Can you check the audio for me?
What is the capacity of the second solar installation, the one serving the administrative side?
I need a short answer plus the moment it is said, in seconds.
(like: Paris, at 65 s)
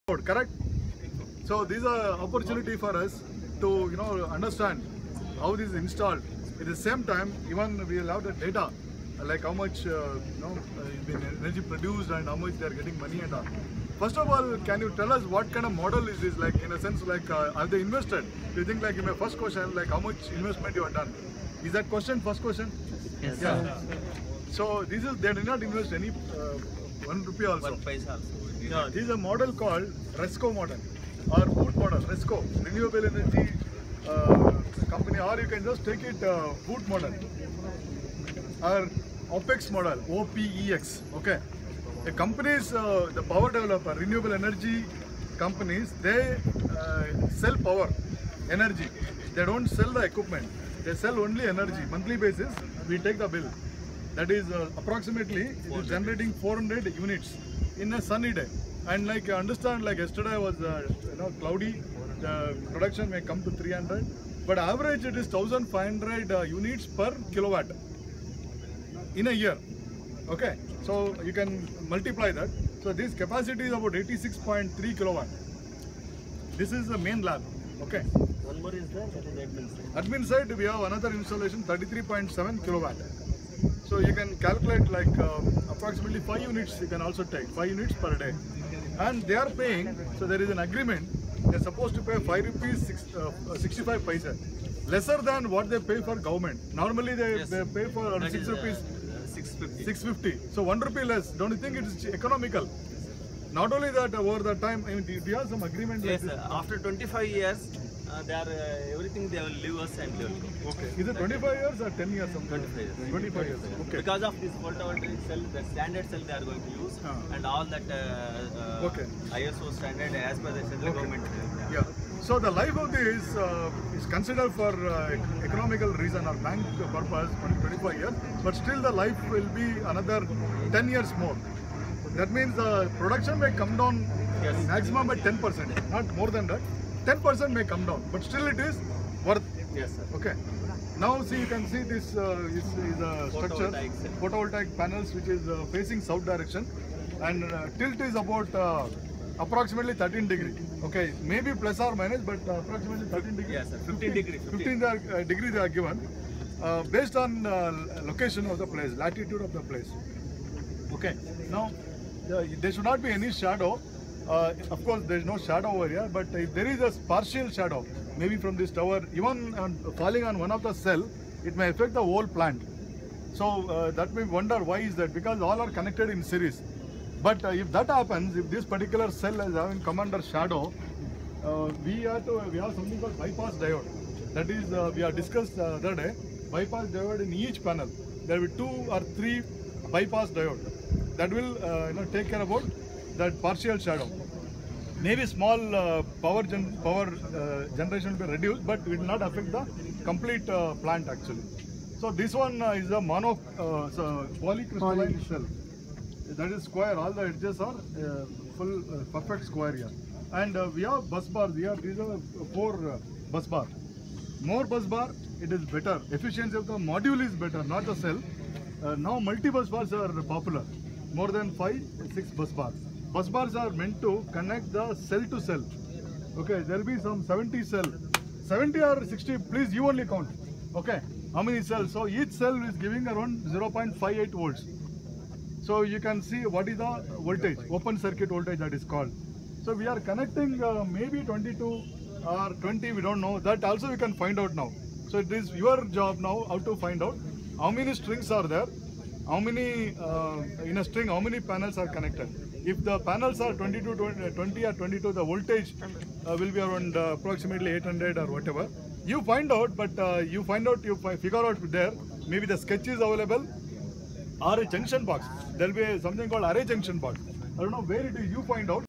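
33.7 kilowatt, at 81 s.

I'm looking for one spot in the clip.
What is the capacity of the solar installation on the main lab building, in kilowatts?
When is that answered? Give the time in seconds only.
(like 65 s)
73 s.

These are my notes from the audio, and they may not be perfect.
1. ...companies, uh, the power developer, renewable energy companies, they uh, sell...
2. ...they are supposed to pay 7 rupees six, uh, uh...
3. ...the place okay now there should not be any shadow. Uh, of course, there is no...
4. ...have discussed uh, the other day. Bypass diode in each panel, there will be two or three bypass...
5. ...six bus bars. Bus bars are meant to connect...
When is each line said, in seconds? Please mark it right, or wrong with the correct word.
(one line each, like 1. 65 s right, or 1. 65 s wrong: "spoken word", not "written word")
1. 42 s right
2. 91 s wrong: "5", not "7"
3. 159 s right
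4. 185 s right
5. 222 s right.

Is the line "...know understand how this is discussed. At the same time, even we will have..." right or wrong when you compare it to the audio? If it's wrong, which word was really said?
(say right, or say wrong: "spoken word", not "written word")
wrong: "installed", not "discussed".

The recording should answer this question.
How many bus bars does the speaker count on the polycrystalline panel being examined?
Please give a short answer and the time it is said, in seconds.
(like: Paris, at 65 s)
4, at 212 s.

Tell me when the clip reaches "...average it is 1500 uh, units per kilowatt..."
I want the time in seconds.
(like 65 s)
64 s.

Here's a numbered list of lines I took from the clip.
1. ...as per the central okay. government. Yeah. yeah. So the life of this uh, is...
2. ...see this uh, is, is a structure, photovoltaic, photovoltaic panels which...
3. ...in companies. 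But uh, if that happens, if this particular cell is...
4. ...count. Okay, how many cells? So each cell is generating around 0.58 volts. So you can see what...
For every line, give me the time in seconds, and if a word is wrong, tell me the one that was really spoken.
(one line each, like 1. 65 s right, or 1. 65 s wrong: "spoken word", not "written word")
1. 120 s right
2. 141 s right
3. 176 s wrong: "series", not "companies"
4. 230 s wrong: "giving", not "generating".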